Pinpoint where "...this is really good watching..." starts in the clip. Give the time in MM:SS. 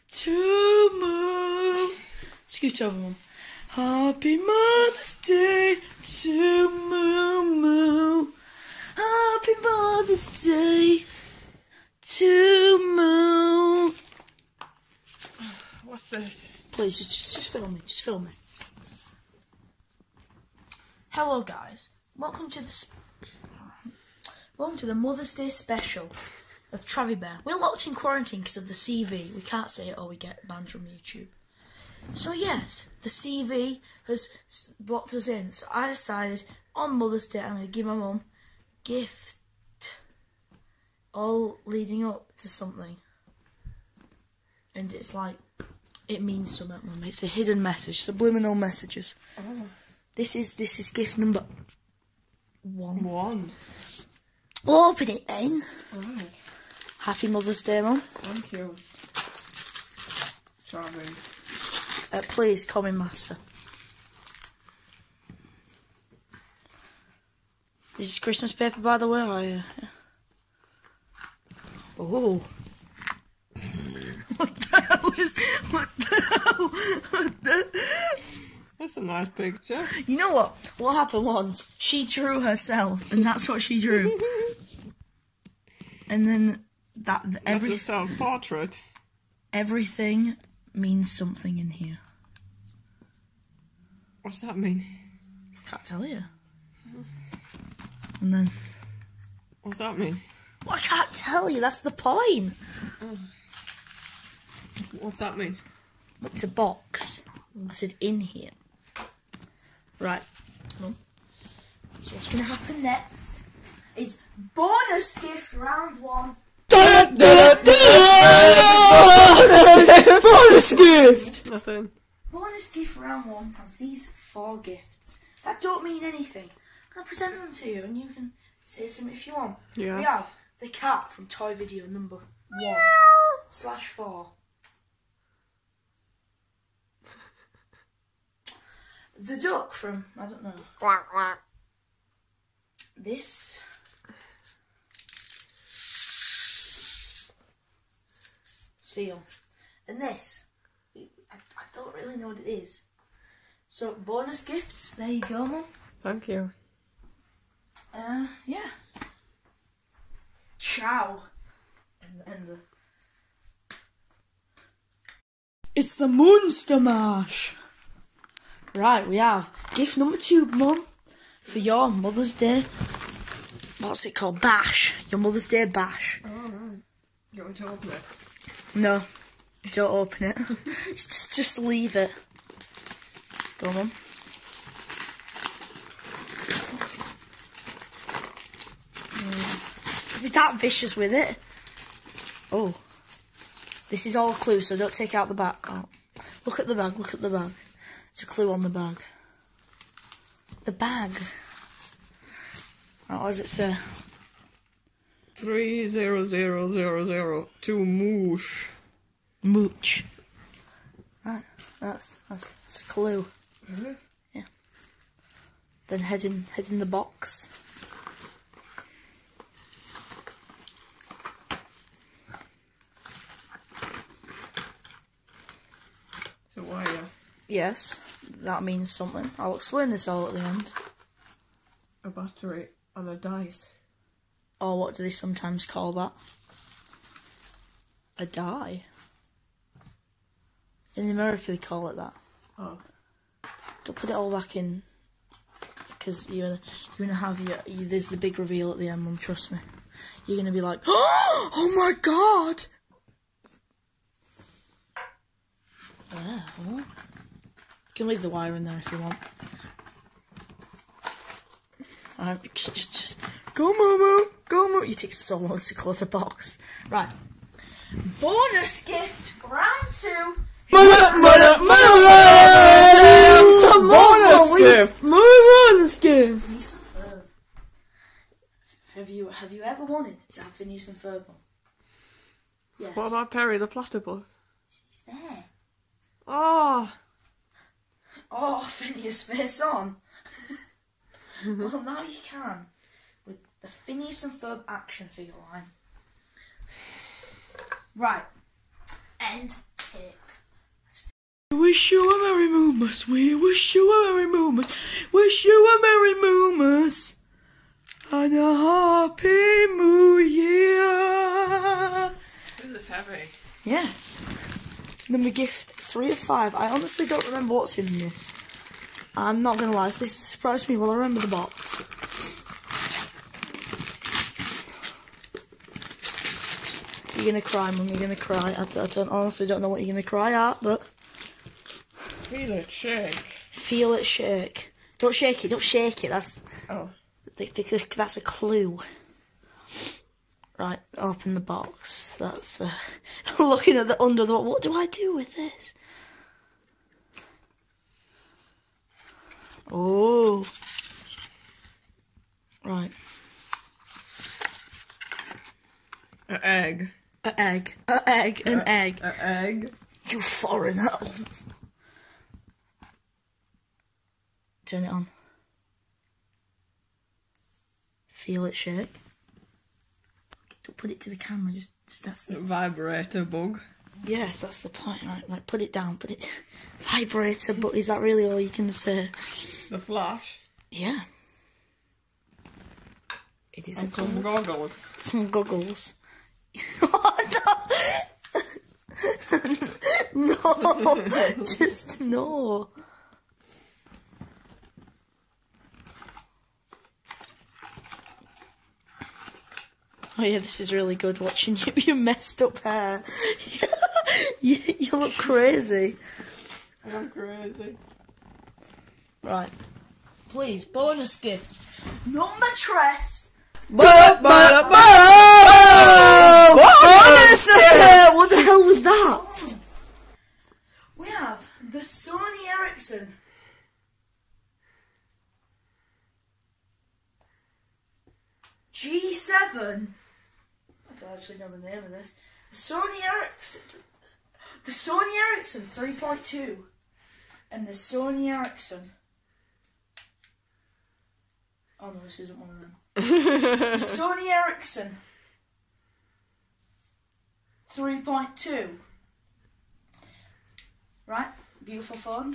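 06:40.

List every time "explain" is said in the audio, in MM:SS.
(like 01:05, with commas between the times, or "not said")
03:49.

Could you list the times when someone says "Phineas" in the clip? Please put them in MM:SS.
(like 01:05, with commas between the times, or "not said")
04:40, 04:48, 04:53.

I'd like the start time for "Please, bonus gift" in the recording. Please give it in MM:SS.
06:50.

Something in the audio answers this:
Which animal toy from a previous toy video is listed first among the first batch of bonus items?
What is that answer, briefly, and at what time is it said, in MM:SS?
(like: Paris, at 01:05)
The cat, at 02:10.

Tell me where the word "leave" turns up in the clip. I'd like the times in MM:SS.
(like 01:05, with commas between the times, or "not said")
03:01, 04:18.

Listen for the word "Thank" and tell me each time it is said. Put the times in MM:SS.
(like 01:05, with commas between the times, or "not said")
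00:58, 02:36.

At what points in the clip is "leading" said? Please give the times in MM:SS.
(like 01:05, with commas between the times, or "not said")
00:41.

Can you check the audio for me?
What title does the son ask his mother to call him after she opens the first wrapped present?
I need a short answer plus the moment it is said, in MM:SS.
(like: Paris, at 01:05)
Master, at 01:02.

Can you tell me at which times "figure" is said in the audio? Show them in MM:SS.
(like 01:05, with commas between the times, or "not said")
04:55.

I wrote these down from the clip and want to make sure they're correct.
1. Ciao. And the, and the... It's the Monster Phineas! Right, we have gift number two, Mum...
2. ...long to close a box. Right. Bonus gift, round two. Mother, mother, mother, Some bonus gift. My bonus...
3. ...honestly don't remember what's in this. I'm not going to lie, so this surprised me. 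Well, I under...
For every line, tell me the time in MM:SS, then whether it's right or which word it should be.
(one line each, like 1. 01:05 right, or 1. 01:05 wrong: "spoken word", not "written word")
1. 02:40 wrong: "Mash", not "Phineas"
2. 04:25 right
3. 05:16 wrong: "remember", not "under".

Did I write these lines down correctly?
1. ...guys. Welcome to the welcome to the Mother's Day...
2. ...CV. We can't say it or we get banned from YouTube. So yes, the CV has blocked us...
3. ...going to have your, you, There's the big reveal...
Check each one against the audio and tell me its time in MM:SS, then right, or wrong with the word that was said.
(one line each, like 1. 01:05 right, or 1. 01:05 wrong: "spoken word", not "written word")
1. 00:21 right
2. 00:28 right
3. 04:07 right.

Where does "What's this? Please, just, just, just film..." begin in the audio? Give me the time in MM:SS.
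00:15.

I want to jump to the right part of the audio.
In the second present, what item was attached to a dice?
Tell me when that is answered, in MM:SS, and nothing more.
03:52.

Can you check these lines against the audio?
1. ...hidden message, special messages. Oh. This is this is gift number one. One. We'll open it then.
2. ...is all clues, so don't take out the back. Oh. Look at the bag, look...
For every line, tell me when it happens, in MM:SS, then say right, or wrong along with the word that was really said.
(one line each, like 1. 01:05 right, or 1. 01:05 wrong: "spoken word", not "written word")
1. 00:47 wrong: "subliminal", not "special"
2. 03:14 right.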